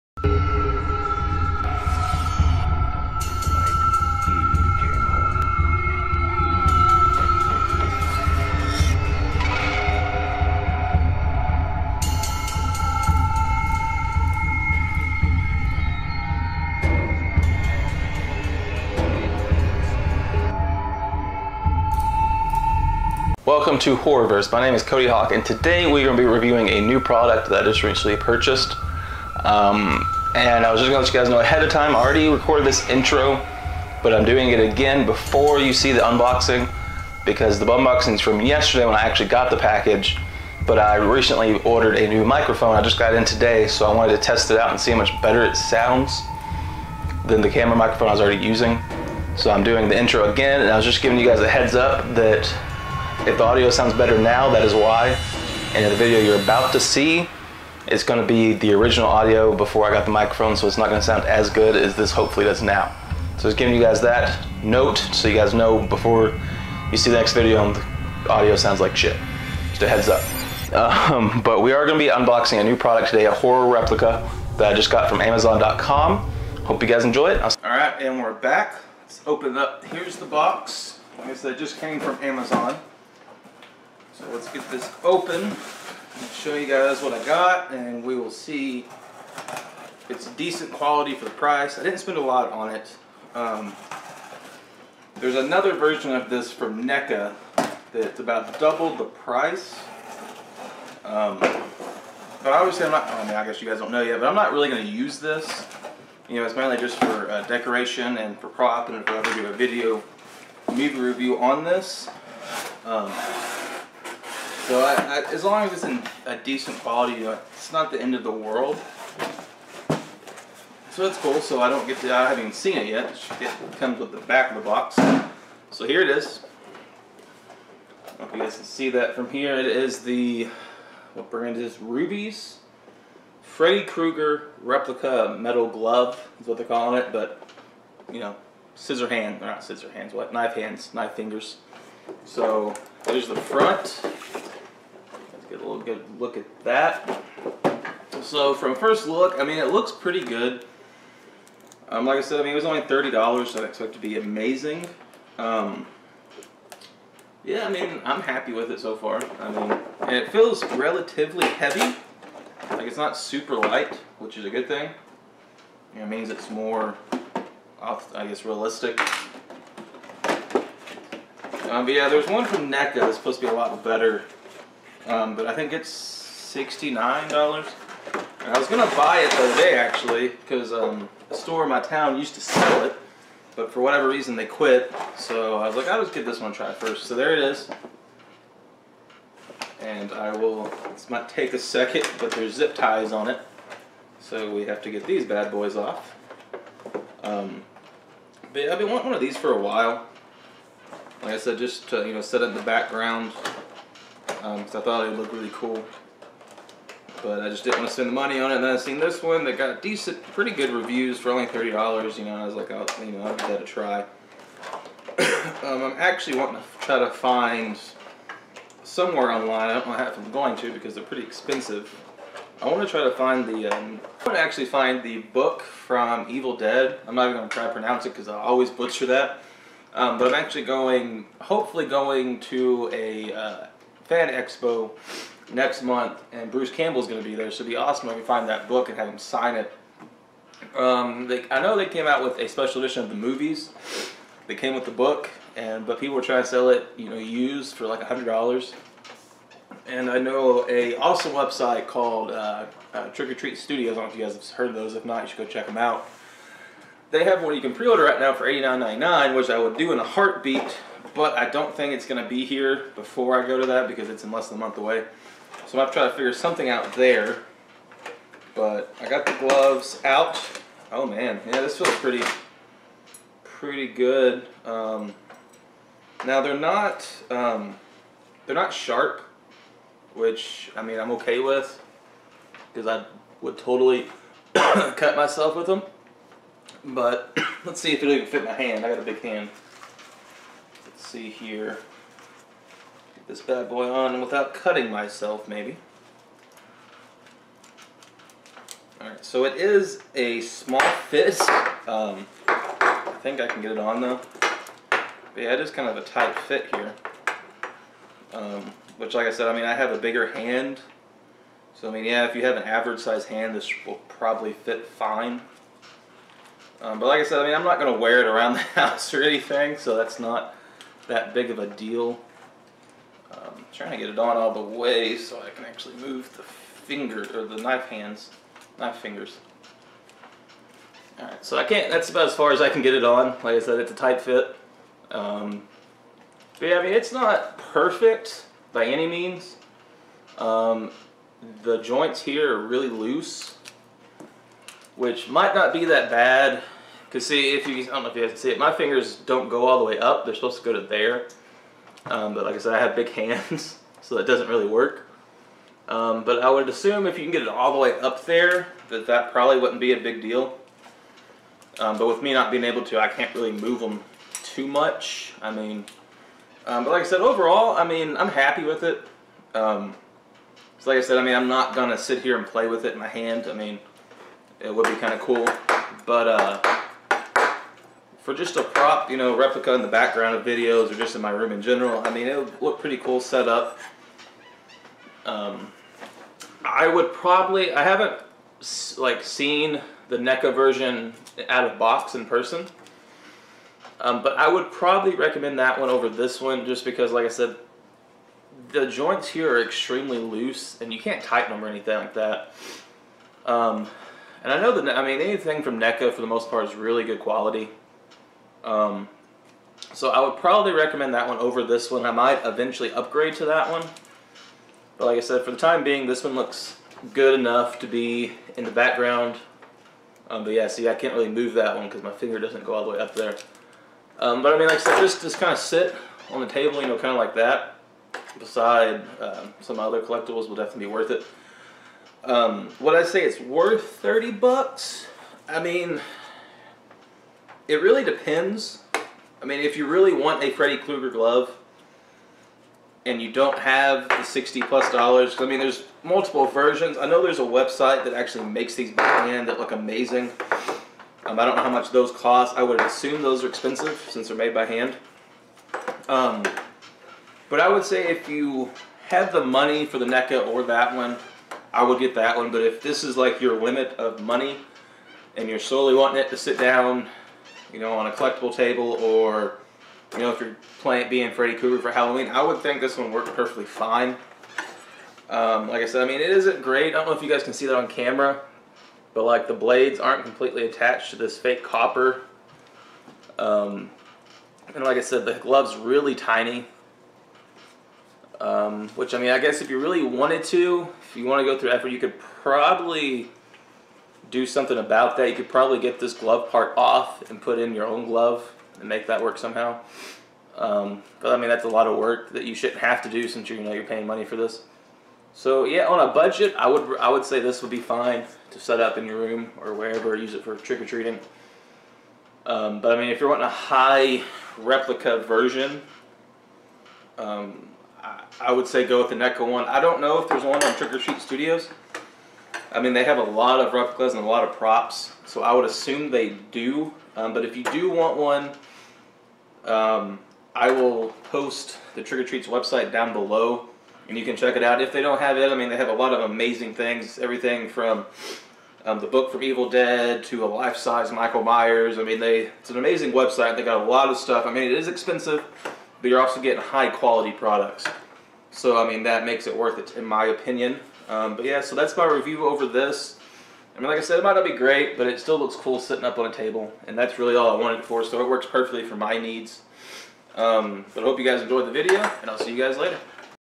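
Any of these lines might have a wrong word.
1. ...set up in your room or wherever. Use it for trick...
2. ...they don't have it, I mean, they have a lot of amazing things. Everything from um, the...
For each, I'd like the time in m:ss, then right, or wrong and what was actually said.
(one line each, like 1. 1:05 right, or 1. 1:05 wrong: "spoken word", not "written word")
1. 8:28 right
2. 8:54 right.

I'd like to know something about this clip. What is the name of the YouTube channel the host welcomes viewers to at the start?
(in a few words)
Horrorverse.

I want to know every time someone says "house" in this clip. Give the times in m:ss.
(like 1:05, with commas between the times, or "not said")
5:18.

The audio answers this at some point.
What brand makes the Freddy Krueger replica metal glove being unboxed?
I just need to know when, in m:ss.
2:11.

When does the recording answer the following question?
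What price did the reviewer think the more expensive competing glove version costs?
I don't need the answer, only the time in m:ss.
2:56.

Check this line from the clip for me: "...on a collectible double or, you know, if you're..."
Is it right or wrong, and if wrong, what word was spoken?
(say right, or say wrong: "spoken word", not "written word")
wrong: "table", not "double".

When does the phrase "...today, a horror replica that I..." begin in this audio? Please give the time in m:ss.
1:13.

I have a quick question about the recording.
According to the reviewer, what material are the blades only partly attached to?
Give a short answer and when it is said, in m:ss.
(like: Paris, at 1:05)
fake copper, at 8:01.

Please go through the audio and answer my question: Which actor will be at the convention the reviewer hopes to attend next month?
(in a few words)
Bruce Campbell.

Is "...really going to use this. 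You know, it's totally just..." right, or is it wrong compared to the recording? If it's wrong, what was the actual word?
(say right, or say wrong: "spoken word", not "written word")
wrong: "mainly", not "totally".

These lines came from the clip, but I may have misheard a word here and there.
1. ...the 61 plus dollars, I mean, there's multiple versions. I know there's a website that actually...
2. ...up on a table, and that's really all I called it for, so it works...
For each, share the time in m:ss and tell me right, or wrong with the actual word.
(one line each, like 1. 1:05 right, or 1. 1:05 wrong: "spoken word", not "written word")
1. 7:24 wrong: "60", not "61"
2. 9:16 wrong: "wanted", not "called".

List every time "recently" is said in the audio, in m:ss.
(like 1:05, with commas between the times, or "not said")
0:27, 0:40.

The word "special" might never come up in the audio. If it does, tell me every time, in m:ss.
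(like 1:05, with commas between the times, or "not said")
4:02.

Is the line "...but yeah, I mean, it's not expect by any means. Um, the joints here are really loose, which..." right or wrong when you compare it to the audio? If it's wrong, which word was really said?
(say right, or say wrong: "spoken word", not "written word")
wrong: "perfect", not "expect".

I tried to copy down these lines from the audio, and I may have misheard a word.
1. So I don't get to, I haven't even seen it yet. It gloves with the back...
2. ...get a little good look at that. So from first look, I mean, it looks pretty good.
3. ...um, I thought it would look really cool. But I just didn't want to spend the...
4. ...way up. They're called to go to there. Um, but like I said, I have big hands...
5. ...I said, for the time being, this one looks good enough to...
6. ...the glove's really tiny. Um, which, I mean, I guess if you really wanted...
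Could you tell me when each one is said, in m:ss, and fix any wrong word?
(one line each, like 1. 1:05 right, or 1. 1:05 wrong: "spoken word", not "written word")
1. 2:01 wrong: "comes", not "gloves"
2. 2:25 right
3. 3:24 right
4. 5:49 wrong: "supposed", not "called"
5. 6:55 right
6. 8:05 right.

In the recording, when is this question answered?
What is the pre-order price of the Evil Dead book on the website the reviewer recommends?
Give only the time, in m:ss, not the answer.
4:18.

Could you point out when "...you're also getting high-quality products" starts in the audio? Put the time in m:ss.
9:06.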